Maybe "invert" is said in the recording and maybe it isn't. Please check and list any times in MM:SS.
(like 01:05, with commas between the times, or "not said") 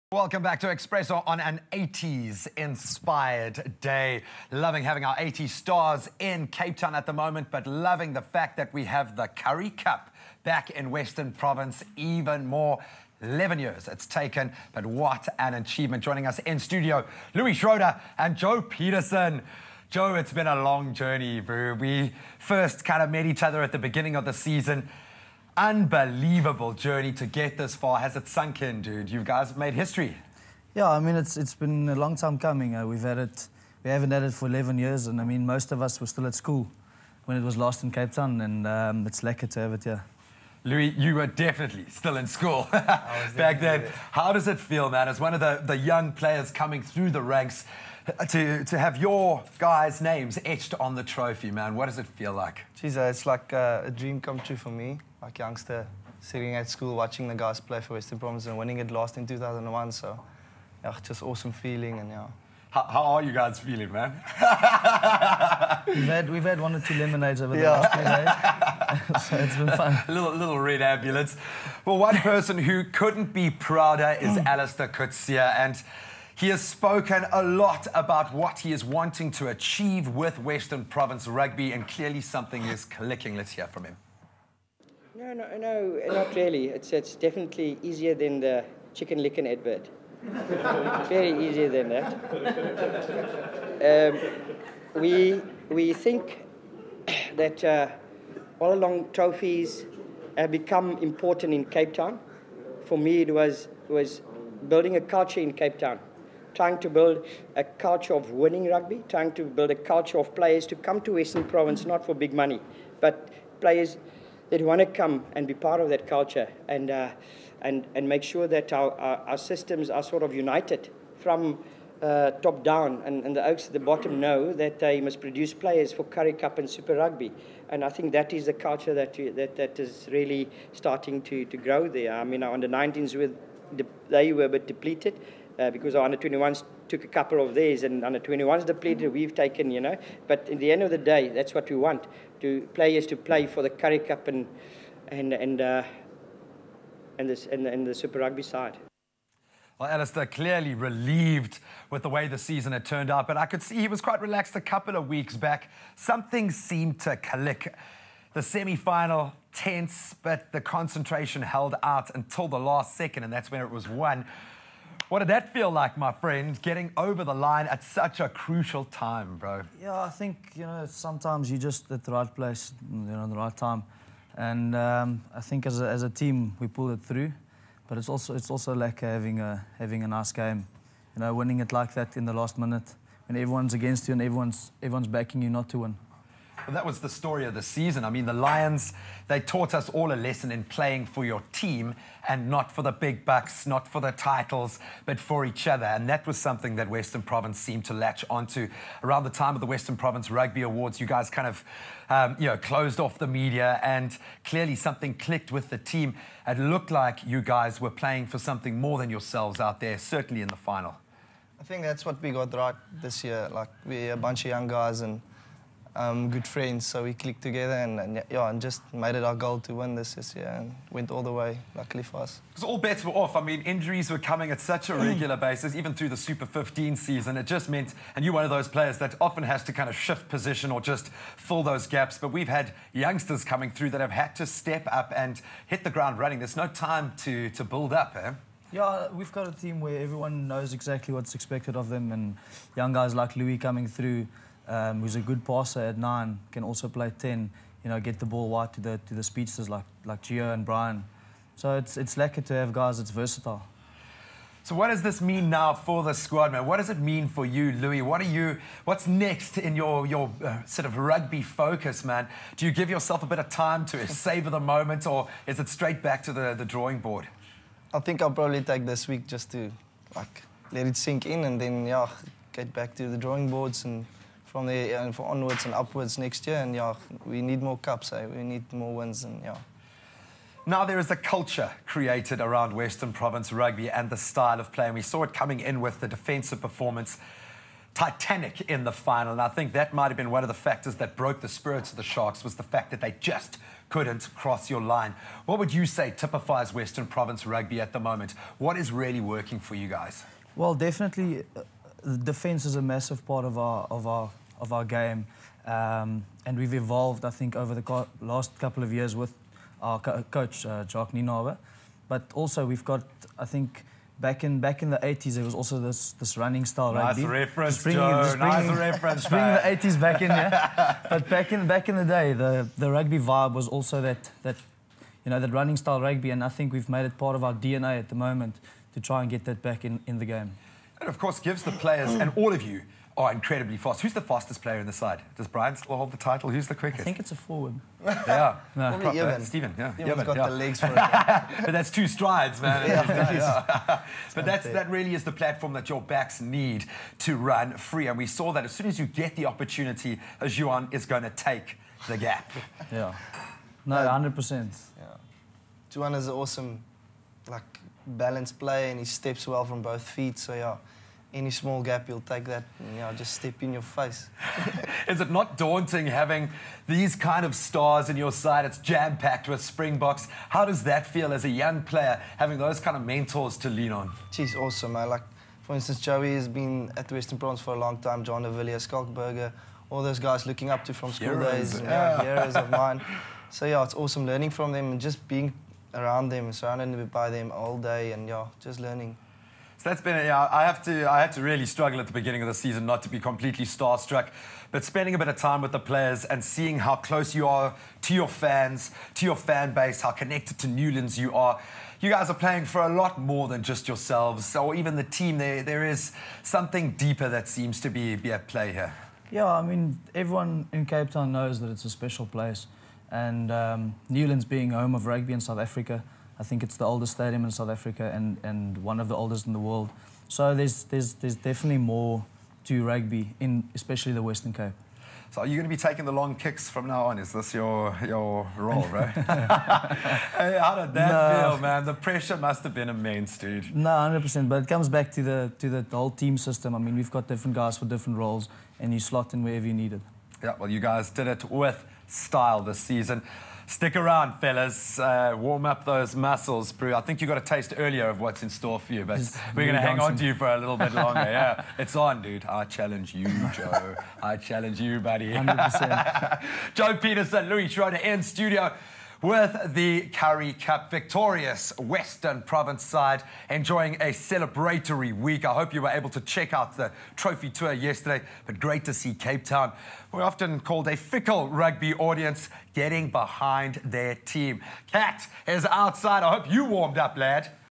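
not said.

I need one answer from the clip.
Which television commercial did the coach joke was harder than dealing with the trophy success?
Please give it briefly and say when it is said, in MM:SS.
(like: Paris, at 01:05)
Chicken Licken advert, at 01:28.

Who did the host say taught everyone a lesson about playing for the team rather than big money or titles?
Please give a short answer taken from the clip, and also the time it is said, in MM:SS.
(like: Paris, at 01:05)
The Lions, at 03:08.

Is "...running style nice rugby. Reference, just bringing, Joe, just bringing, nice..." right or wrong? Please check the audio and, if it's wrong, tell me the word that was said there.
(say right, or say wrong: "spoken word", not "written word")
right.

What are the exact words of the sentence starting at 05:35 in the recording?
Does Bryan still hold the title?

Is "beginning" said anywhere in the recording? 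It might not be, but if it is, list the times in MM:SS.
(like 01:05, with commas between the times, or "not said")
00:23, 06:32.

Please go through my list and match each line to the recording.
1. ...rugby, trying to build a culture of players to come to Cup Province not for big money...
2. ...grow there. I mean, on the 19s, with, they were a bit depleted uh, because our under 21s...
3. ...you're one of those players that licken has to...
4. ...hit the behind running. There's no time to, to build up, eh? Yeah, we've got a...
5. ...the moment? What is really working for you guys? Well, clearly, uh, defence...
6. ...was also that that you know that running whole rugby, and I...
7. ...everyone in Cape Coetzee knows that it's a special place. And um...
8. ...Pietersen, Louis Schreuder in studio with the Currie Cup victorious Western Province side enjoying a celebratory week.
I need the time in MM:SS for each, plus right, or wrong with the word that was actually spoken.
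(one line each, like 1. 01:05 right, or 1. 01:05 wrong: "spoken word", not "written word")
1. 01:48 wrong: "Western", not "Cup"
2. 02:11 right
3. 03:48 wrong: "often", not "licken"
4. 03:55 wrong: "ground", not "behind"
5. 04:57 wrong: "definitely", not "clearly"
6. 05:23 wrong: "style", not "whole"
7. 06:50 wrong: "Town", not "Coetzee"
8. 07:36 right.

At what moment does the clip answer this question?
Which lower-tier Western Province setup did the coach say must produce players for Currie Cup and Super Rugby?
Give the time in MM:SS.
02:03.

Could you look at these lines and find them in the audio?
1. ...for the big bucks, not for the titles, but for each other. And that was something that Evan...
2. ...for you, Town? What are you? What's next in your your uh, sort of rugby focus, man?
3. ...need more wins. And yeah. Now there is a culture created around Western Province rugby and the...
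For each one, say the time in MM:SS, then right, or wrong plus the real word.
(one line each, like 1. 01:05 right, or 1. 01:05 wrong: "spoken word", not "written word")
1. 03:12 wrong: "Western", not "Evan"
2. 04:17 wrong: "Louis", not "Town"
3. 04:38 right.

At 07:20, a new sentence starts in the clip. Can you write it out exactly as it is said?
Yeah, well, you guys did it with style this season.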